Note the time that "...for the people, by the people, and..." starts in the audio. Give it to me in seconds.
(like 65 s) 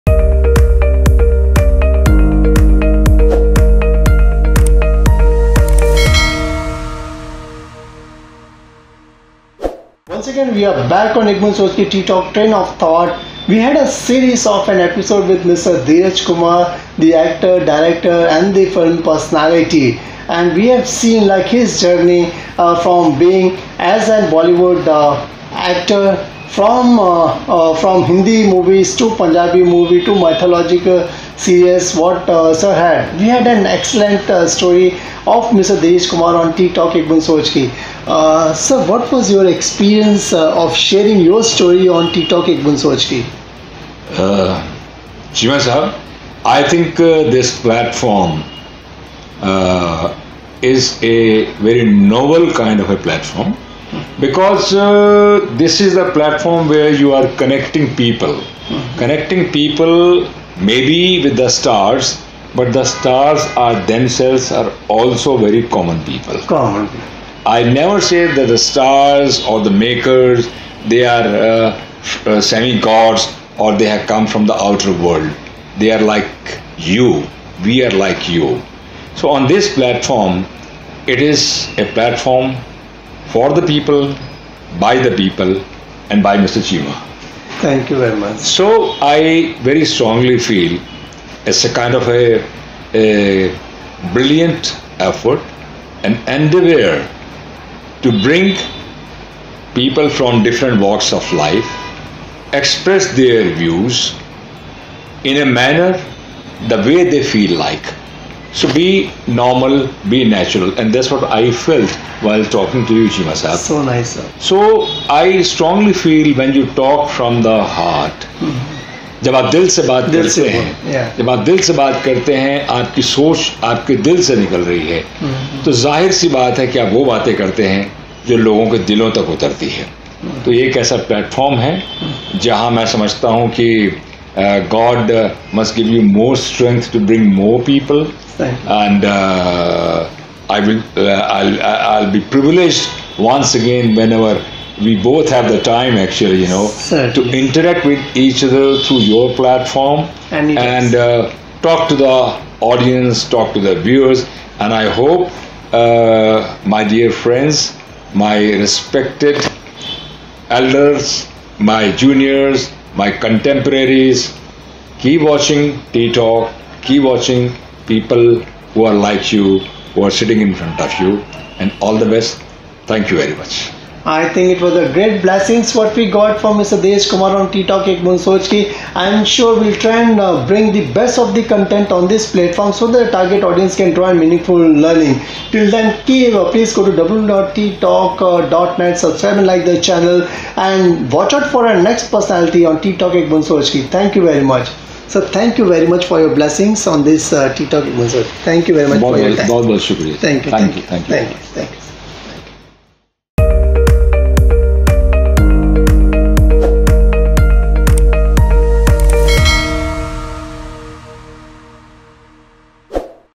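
83 s.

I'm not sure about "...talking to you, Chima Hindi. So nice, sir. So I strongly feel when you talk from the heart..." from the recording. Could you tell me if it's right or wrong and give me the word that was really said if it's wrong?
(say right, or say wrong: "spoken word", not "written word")
wrong: "Saab", not "Hindi".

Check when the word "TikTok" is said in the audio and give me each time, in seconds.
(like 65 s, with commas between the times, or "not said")
36 s, 42 s.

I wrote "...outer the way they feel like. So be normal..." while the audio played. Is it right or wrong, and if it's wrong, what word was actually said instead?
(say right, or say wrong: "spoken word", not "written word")
wrong: "manner", not "outer".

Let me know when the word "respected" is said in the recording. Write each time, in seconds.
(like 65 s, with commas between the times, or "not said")
158 s.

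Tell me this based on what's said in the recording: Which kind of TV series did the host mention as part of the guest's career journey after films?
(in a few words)
mythological series.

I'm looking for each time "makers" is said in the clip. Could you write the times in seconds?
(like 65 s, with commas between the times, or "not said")
69 s.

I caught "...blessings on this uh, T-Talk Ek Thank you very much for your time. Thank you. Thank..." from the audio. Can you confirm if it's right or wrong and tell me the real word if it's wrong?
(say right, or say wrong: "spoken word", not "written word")
right.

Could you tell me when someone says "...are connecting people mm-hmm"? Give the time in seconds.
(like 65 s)
57 s.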